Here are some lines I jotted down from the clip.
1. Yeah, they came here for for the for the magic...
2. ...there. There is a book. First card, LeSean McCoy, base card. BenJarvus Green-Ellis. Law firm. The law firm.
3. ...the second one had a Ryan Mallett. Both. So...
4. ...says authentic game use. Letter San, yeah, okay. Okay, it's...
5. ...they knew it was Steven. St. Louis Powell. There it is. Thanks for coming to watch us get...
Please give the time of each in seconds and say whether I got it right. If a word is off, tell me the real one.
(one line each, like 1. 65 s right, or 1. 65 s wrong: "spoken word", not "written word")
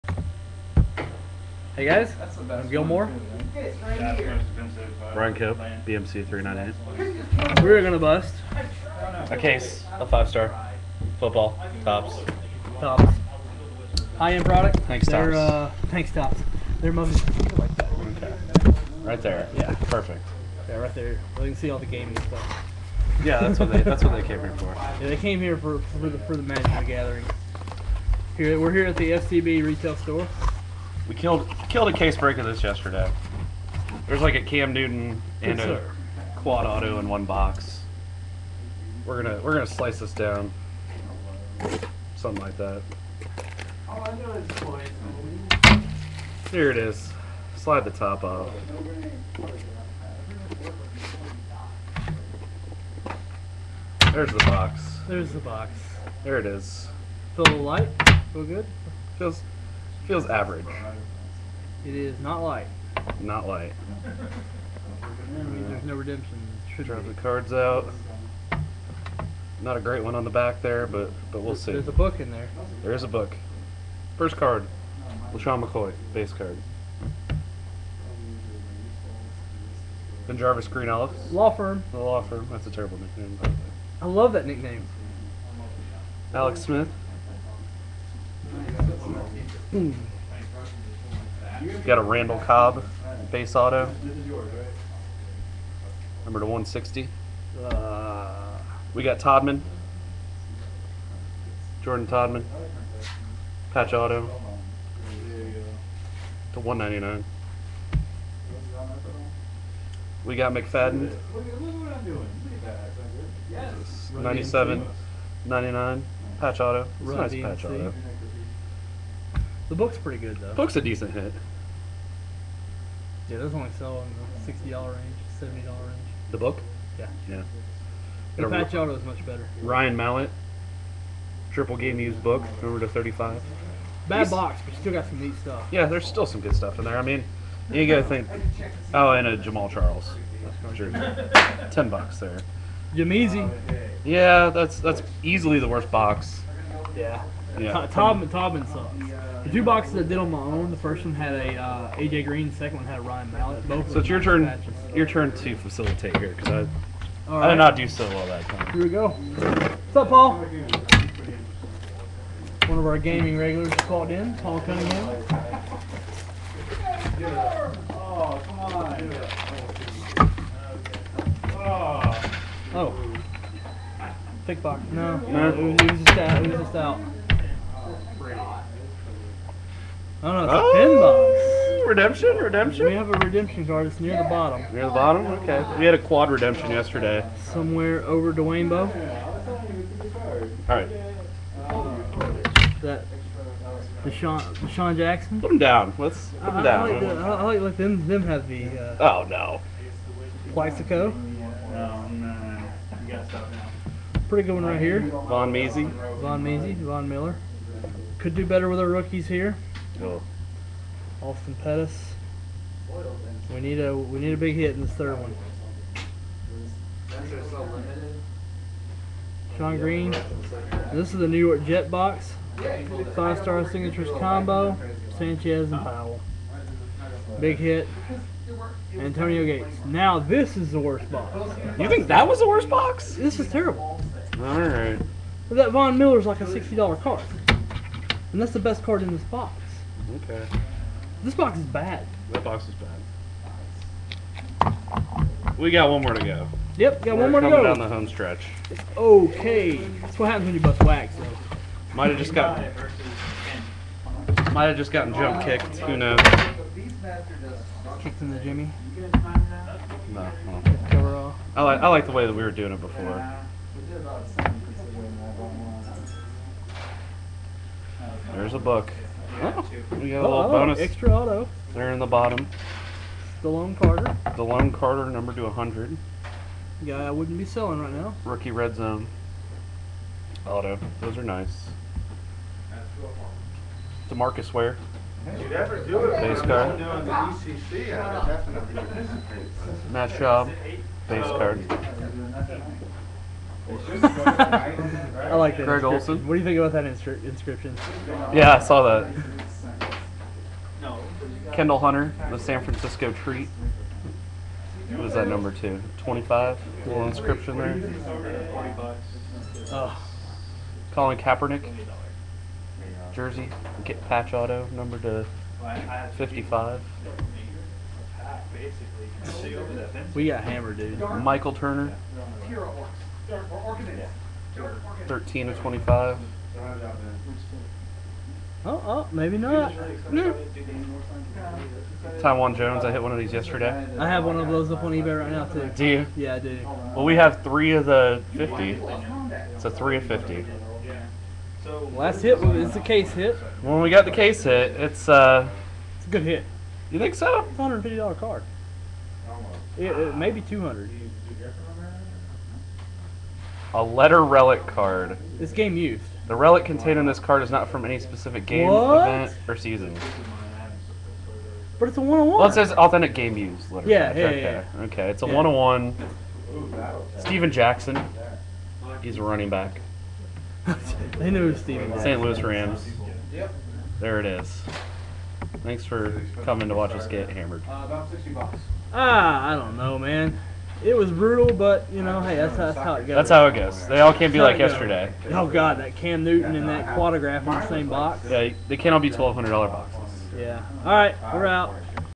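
1. 24 s right
2. 72 s right
3. 152 s right
4. 362 s wrong: "Yeah", not "San"
5. 371 s wrong: "Rams", not "Powell".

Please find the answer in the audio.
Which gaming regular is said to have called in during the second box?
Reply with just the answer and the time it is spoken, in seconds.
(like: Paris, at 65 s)
Paul Cunningham, at 164 s.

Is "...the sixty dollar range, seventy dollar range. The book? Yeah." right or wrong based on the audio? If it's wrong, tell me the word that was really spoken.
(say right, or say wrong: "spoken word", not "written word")
right.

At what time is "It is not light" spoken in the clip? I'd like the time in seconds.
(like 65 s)
61 s.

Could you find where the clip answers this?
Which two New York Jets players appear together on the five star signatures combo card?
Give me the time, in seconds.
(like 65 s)
225 s.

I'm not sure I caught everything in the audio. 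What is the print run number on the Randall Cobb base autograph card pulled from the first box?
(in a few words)
160.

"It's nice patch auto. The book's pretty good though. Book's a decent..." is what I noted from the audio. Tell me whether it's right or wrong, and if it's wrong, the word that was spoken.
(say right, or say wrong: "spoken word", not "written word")
right.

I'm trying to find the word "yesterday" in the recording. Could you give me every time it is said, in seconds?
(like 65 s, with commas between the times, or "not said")
32 s, 186 s, 333 s, 384 s.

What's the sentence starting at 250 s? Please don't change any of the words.
That's what happens when you bust wax.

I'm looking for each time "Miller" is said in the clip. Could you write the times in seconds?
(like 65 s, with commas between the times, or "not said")
207 s, 235 s.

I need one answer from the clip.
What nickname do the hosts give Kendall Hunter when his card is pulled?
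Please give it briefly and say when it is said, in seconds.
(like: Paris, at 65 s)
The San Francisco treat, at 302 s.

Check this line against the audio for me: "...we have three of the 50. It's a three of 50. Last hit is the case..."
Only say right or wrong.
right.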